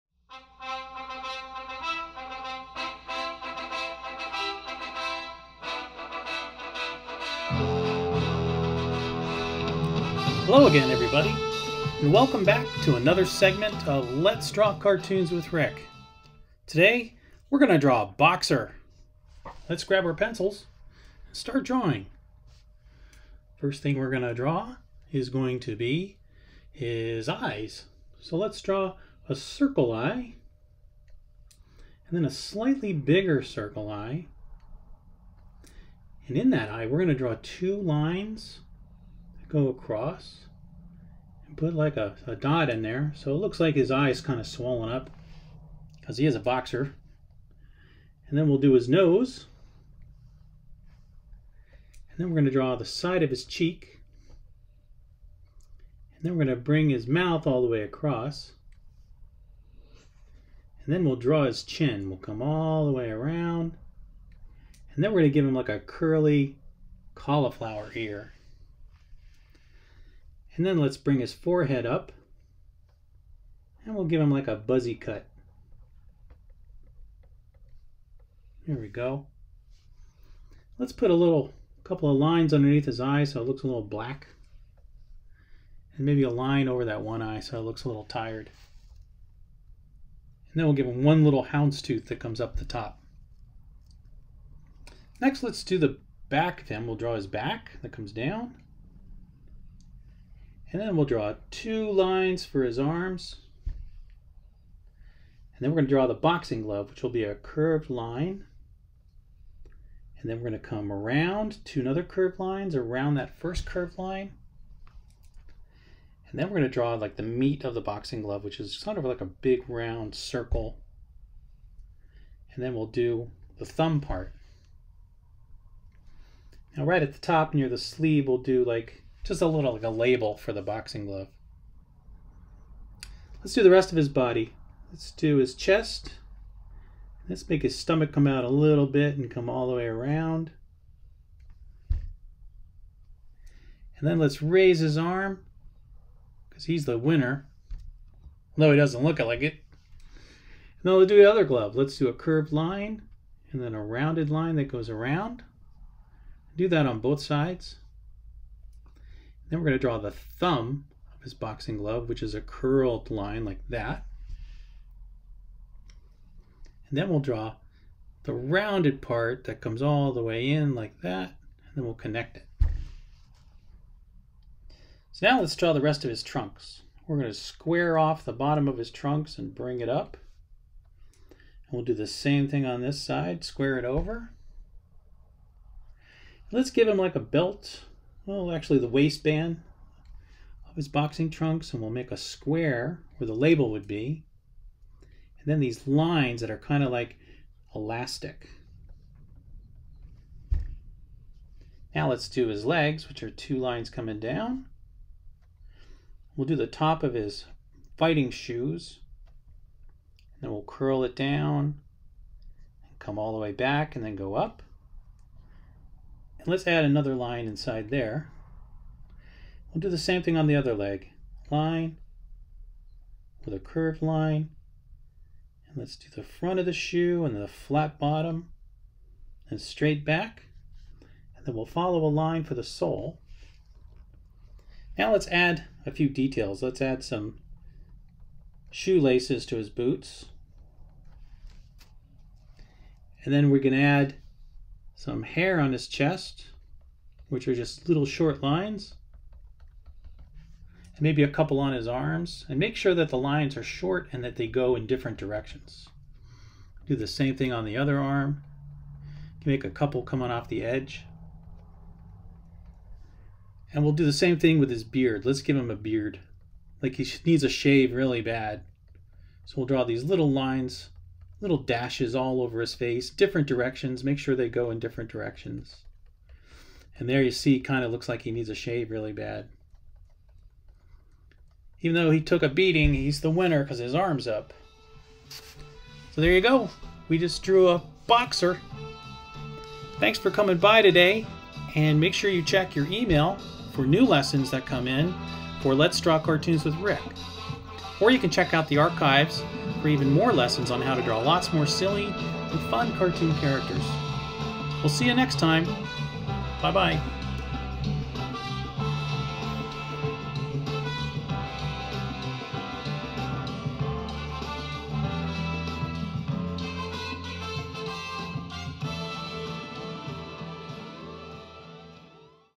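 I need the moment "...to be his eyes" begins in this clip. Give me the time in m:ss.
0:25.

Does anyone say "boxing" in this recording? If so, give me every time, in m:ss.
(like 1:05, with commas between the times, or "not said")
1:46, 1:57, 2:10, 2:41, 3:10.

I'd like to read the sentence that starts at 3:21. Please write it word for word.
Now let's do his legs, which are two lines coming down.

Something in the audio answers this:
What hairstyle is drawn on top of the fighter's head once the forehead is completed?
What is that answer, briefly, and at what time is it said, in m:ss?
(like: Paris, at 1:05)
Buzzy cut, at 1:14.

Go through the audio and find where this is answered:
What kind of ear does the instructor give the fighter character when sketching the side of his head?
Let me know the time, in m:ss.
1:05.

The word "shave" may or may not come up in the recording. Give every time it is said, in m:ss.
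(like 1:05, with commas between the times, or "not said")
4:27, 4:38.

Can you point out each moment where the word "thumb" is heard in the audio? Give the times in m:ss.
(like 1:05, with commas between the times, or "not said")
2:03, 2:40.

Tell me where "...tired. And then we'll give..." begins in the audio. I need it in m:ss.
1:28.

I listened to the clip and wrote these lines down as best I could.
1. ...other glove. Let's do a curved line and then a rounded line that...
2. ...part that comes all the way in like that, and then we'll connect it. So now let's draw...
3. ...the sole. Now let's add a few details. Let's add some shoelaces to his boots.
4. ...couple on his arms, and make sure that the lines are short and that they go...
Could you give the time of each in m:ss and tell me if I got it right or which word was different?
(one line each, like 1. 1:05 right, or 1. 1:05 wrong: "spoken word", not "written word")
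1. 2:31 right
2. 2:49 right
3. 3:52 right
4. 4:11 right.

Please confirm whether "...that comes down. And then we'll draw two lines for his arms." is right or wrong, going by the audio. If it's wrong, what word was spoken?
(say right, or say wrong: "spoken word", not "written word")
right.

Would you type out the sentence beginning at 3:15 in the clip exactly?
And then these lines that are kind of like elastic.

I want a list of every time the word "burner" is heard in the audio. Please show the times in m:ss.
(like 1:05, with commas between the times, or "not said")
not said.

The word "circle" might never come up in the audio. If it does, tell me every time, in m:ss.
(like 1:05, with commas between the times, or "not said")
0:29, 0:33, 2:00.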